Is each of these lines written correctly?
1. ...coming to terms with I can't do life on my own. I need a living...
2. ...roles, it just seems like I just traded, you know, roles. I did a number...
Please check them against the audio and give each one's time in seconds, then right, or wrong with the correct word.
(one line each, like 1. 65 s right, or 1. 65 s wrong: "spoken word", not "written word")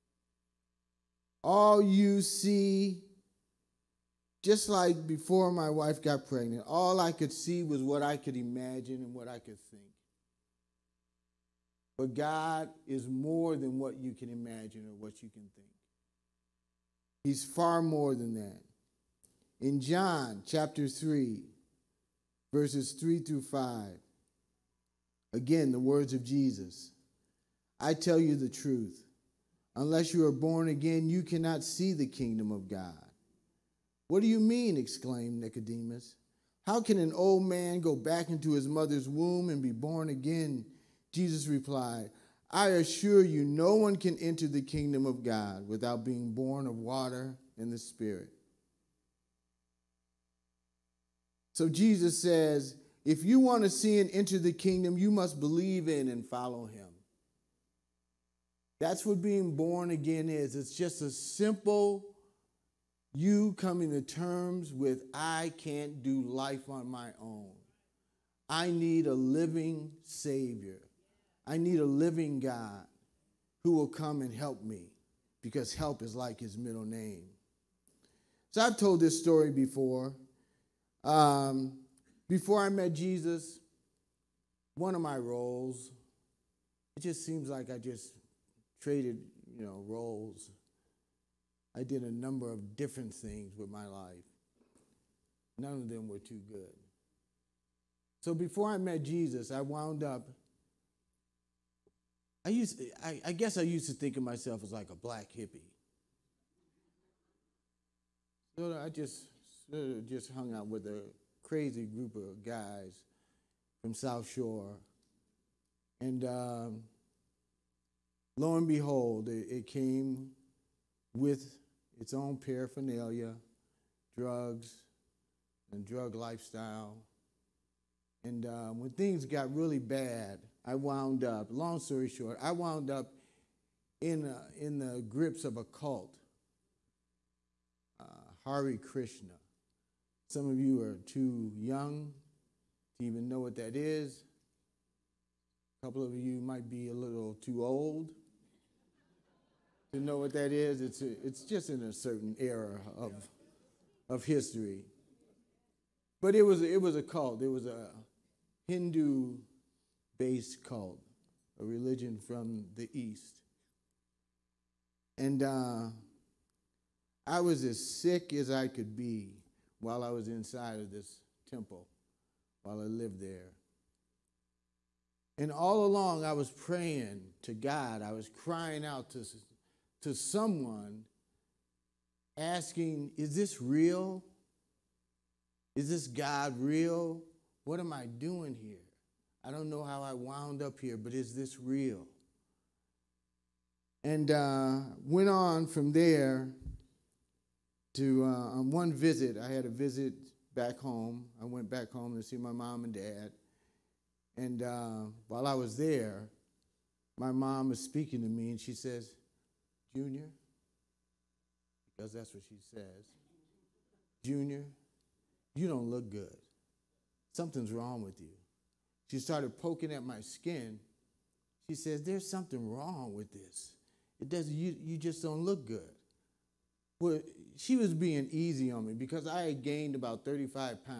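1. 63 s right
2. 85 s right.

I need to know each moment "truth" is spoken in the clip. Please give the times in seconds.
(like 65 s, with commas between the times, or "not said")
28 s.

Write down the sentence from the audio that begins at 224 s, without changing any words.
It doesn't, you, you just don't look good.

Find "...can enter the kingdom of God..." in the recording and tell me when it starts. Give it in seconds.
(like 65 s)
43 s.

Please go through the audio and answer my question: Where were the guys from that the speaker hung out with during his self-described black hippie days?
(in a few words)
South Shore.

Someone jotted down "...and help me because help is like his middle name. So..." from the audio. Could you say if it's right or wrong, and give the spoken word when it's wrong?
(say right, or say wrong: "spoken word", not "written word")
right.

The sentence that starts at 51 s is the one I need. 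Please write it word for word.
So Jesus says, if you want to see and enter the kingdom, you must believe in and follow him.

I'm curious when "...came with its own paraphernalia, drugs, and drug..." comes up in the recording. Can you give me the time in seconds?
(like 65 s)
119 s.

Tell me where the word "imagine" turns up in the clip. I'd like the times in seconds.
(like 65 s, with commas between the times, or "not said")
8 s, 14 s.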